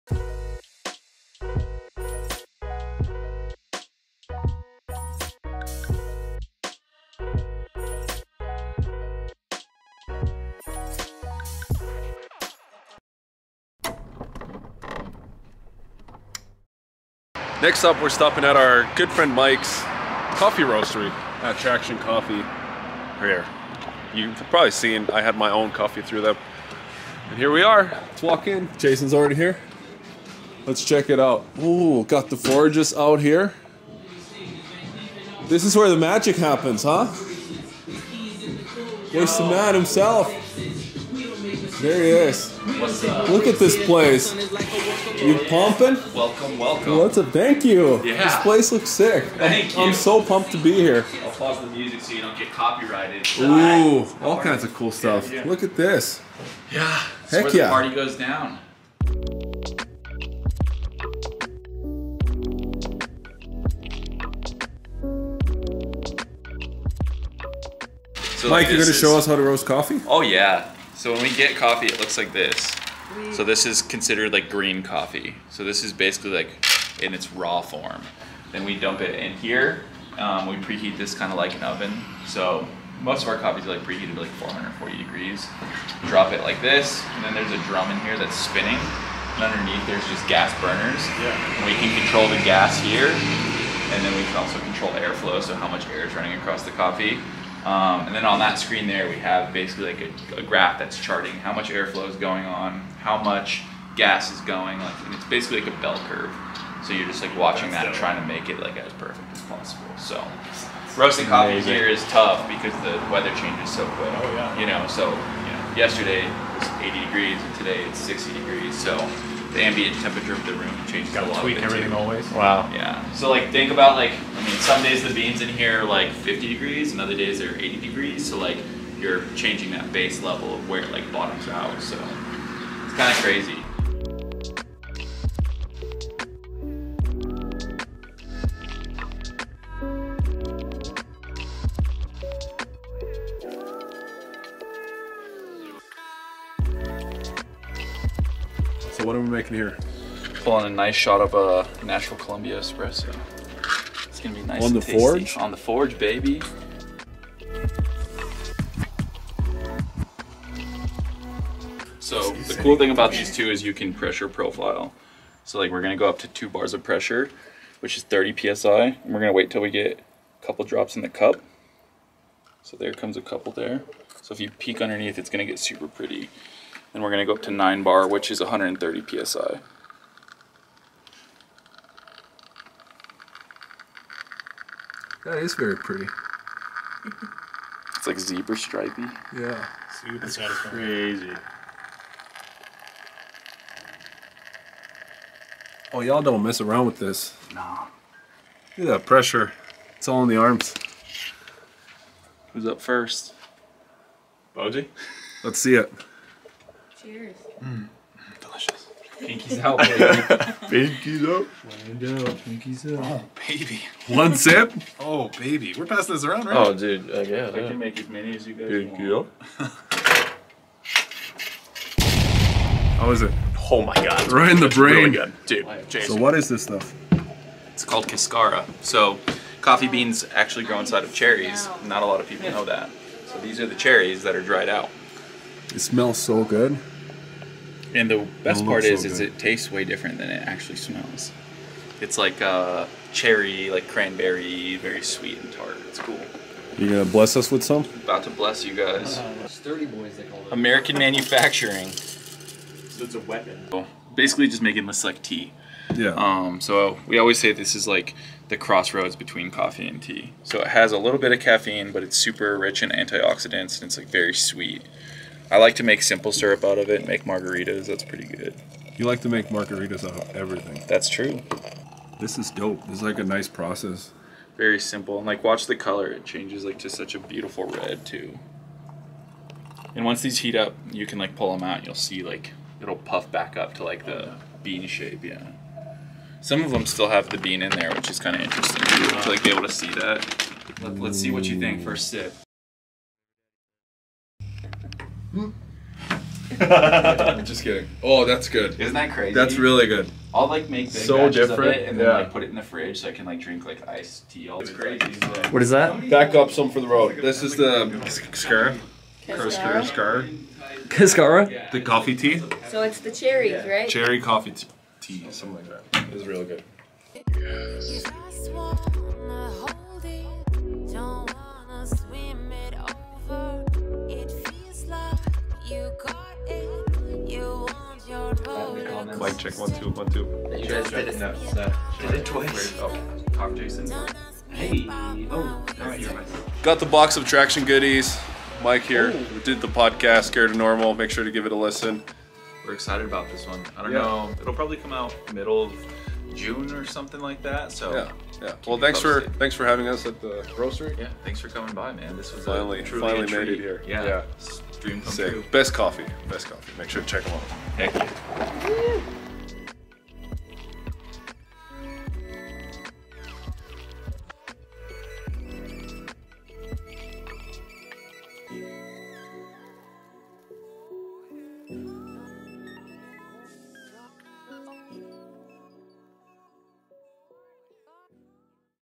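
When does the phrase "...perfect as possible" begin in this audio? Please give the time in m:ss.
1:48.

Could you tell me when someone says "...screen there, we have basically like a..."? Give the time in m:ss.
1:38.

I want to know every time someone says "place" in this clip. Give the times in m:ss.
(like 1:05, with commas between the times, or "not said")
0:43, 0:48.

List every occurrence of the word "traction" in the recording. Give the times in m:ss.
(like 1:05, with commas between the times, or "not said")
0:21, 5:37.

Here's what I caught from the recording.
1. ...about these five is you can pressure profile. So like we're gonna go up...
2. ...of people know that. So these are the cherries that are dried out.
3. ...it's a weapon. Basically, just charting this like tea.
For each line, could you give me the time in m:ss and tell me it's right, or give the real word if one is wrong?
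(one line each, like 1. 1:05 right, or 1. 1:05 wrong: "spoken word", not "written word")
1. 2:42 wrong: "two", not "five"
2. 3:52 right
3. 4:13 wrong: "making", not "charting".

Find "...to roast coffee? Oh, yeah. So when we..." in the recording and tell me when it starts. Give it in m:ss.
1:09.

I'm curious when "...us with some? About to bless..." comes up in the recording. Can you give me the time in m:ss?
4:07.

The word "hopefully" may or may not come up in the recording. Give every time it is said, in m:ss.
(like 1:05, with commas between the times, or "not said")
not said.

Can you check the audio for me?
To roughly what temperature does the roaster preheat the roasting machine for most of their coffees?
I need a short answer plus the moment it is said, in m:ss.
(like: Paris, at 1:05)
440 degrees, at 1:24.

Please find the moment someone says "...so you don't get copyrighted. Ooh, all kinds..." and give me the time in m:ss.
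0:52.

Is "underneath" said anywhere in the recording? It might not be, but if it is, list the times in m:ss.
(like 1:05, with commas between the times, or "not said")
1:29, 2:54.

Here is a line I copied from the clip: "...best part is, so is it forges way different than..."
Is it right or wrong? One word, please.
wrong.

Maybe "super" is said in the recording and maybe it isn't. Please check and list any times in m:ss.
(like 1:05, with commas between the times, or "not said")
2:55, 3:10, 4:22.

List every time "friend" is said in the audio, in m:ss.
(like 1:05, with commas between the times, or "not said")
0:19.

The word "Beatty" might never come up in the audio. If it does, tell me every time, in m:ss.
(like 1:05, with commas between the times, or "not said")
not said.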